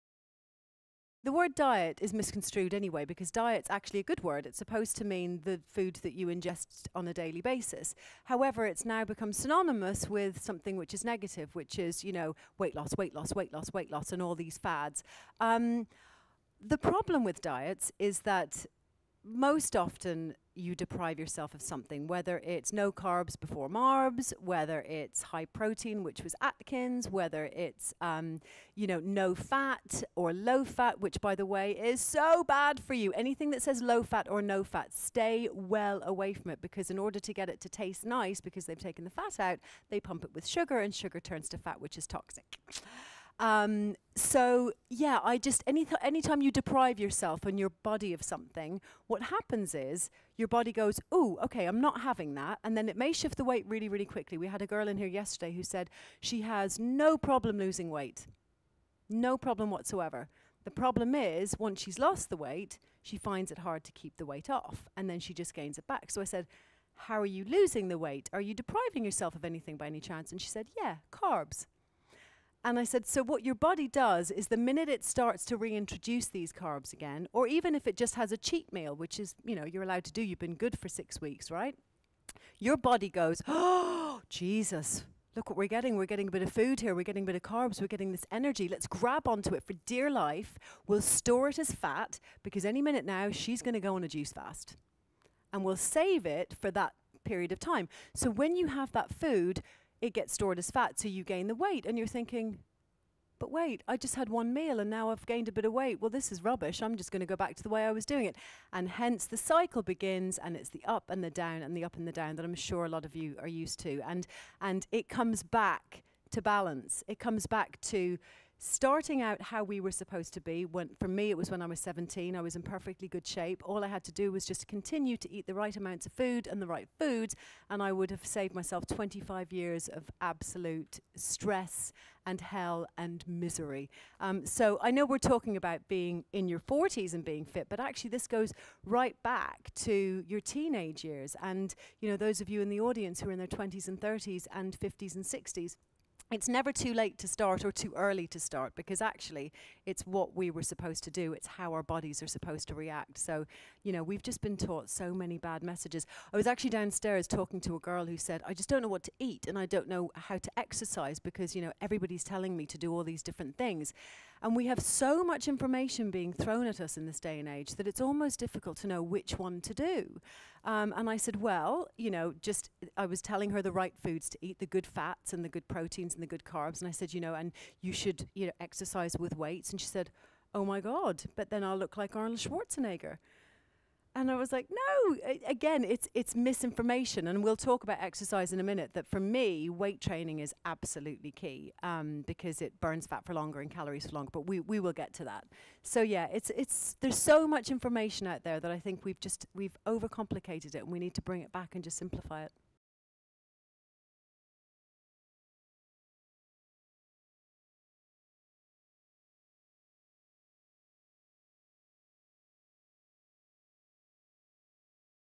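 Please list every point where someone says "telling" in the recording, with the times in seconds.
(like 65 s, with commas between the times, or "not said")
162 s, 173 s.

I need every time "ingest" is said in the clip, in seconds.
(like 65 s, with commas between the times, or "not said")
6 s.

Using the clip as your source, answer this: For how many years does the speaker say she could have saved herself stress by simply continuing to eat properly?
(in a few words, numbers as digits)
25.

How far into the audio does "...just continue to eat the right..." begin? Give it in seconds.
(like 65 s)
124 s.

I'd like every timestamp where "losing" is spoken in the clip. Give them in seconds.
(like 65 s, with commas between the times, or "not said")
57 s, 67 s.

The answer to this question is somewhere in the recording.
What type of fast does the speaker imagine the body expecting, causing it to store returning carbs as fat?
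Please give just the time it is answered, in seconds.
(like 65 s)
94 s.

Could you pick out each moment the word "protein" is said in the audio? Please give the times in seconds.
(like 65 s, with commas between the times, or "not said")
25 s, 175 s.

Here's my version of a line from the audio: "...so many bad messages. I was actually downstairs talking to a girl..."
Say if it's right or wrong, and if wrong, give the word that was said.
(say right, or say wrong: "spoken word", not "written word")
right.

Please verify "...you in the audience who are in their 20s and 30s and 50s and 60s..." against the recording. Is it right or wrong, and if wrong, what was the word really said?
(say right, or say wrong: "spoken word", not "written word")
right.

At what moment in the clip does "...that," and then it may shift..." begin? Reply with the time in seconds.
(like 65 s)
52 s.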